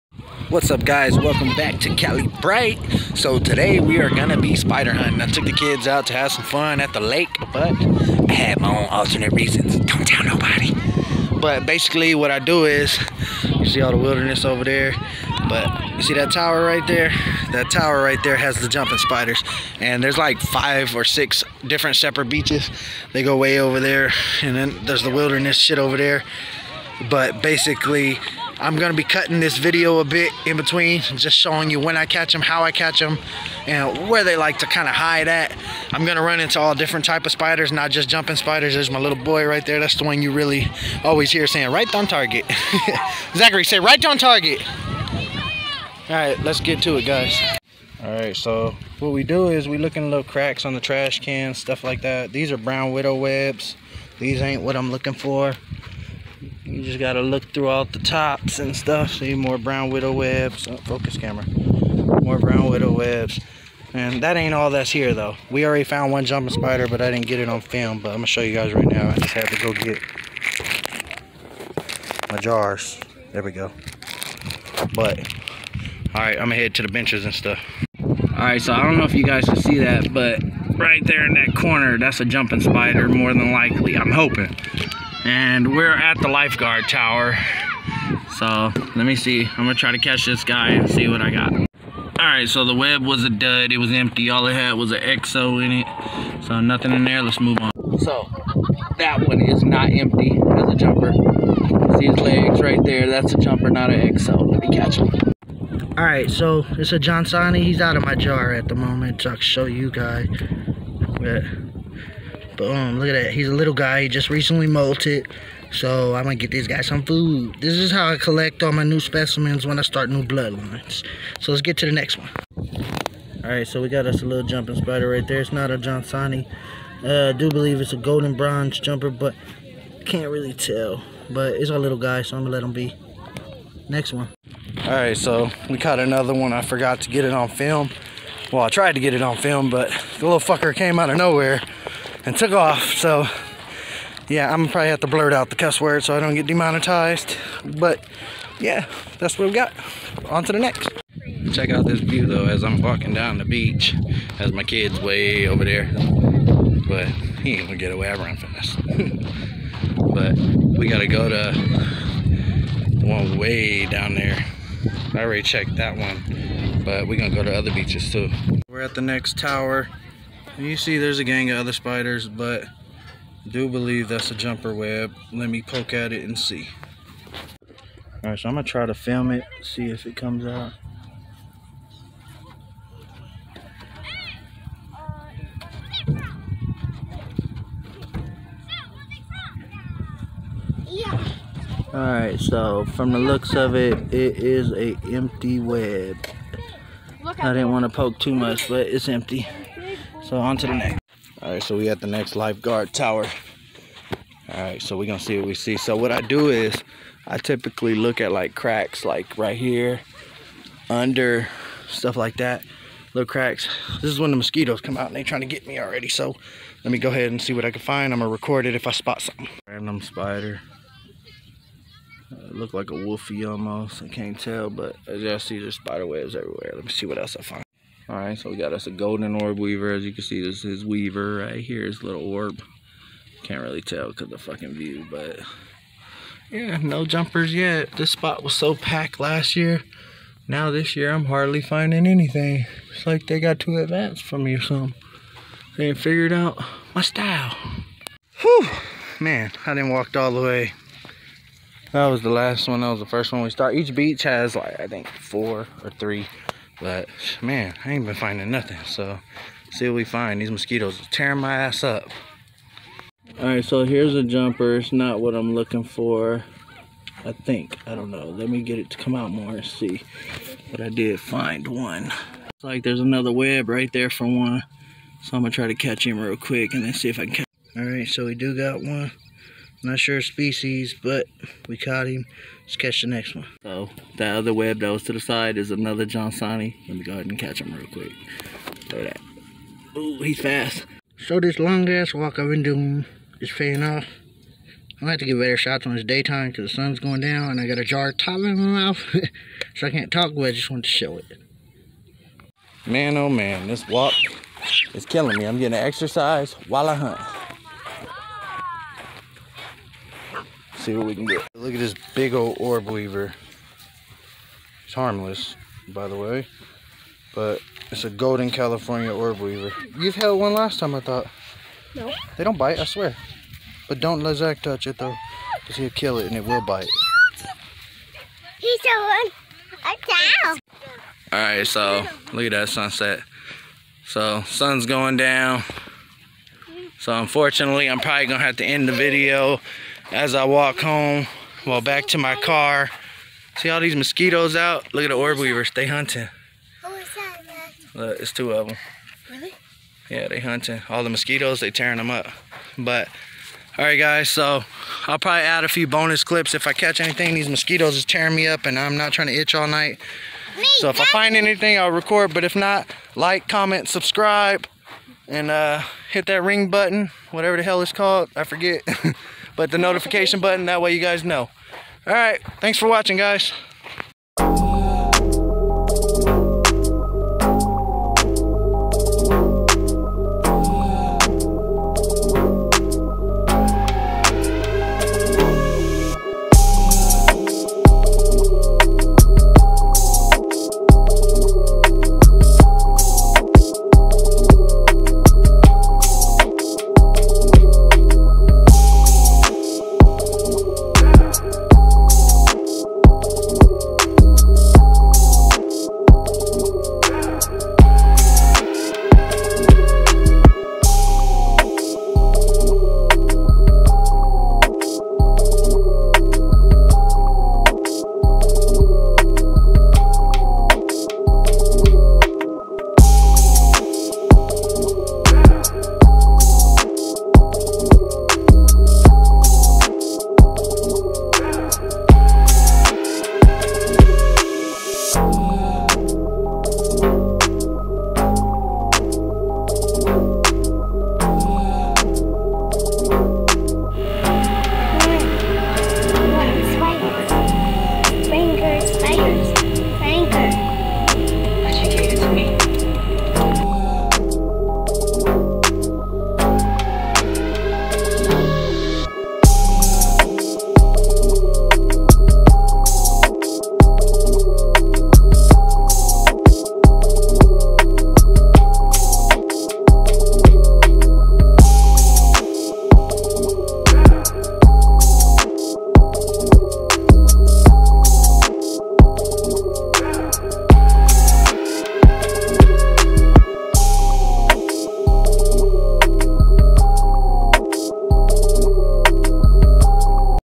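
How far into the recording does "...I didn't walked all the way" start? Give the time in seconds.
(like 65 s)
249 s.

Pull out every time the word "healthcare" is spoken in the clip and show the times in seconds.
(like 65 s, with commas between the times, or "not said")
not said.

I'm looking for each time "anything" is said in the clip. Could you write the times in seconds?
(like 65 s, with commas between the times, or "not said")
242 s, 356 s, 361 s.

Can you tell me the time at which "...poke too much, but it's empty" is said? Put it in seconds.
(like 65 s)
197 s.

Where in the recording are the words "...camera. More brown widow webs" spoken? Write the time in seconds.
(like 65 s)
61 s.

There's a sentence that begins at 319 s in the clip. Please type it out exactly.
You've held one last time, I thought.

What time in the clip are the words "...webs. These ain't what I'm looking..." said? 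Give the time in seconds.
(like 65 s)
53 s.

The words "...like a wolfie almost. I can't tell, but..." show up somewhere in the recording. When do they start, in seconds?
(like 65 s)
222 s.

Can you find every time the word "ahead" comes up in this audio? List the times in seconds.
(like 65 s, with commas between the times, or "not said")
217 s, 287 s.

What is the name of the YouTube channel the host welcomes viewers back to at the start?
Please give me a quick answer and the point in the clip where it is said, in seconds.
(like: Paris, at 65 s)
Cali Bright, at 1 s.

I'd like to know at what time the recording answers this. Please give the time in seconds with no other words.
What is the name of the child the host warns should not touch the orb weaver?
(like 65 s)
324 s.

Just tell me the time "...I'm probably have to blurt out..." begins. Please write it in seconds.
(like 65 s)
144 s.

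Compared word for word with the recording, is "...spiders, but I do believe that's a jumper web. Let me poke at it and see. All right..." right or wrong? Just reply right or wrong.
right.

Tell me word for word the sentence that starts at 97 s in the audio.
So that one is not empty as a jumper.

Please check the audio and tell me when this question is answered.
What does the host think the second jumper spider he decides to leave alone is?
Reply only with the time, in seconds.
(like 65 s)
127 s.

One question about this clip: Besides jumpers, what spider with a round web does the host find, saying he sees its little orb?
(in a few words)
golden orb weaver.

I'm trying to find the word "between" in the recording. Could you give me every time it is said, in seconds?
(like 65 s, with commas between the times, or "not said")
30 s.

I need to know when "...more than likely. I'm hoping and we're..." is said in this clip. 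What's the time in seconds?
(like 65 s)
83 s.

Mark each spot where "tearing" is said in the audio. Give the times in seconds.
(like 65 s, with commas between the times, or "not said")
261 s, 351 s, 358 s.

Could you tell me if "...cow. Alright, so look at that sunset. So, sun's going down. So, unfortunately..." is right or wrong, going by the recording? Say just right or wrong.
right.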